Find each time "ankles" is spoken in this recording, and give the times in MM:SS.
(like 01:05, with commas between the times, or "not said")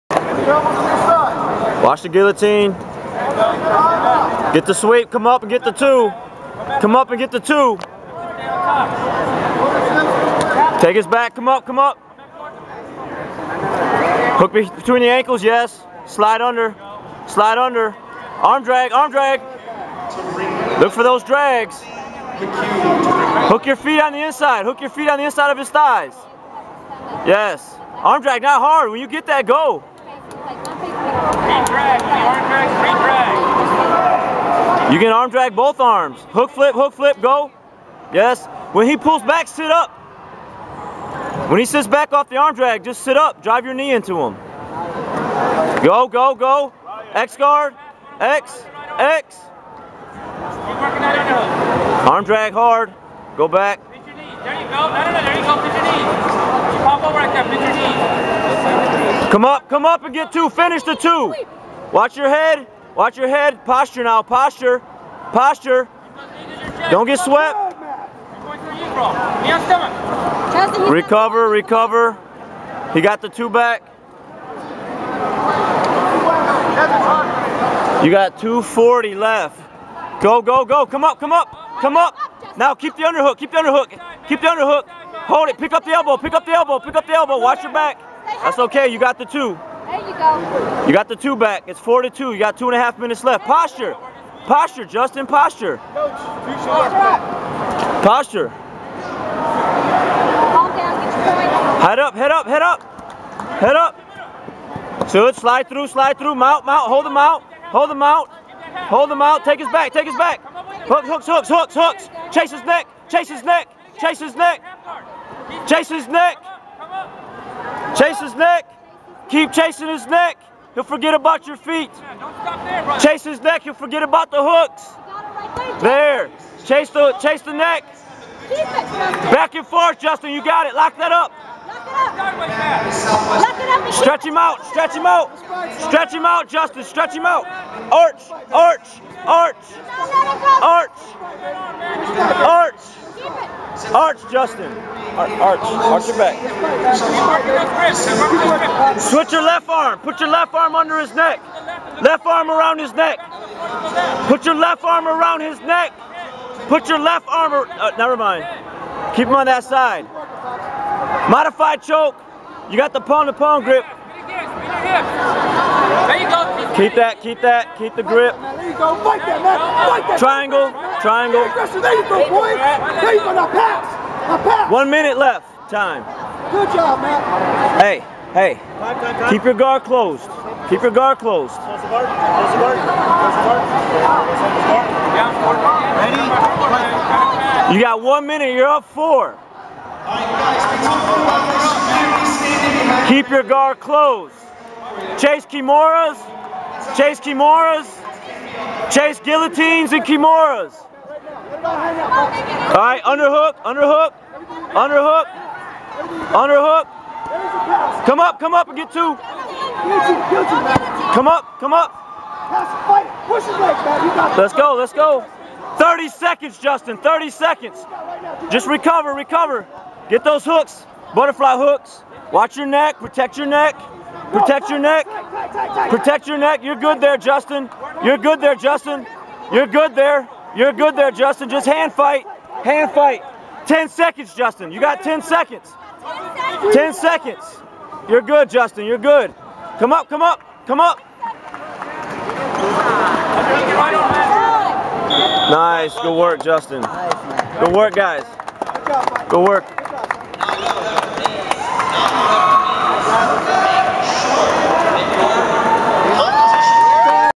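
00:15.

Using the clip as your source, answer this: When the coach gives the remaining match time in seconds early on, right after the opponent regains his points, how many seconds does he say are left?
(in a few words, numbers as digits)
240.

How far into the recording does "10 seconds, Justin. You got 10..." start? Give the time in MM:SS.
03:53.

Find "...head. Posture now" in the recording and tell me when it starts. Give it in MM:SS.
01:03.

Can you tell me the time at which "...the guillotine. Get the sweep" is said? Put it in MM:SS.
00:02.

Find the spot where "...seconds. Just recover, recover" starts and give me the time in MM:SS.
03:37.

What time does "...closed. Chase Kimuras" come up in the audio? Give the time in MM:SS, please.
03:13.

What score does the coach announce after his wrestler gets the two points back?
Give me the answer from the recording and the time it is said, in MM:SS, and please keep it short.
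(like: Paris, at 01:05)
4 to 2, at 01:31.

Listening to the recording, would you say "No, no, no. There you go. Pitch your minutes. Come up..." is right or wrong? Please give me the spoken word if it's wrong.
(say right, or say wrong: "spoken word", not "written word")
wrong: "knees", not "minutes".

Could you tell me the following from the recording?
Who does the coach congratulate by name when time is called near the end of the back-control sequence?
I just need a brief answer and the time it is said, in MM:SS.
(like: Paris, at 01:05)
Matt, at 02:57.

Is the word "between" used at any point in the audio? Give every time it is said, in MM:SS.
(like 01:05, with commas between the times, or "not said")
00:14.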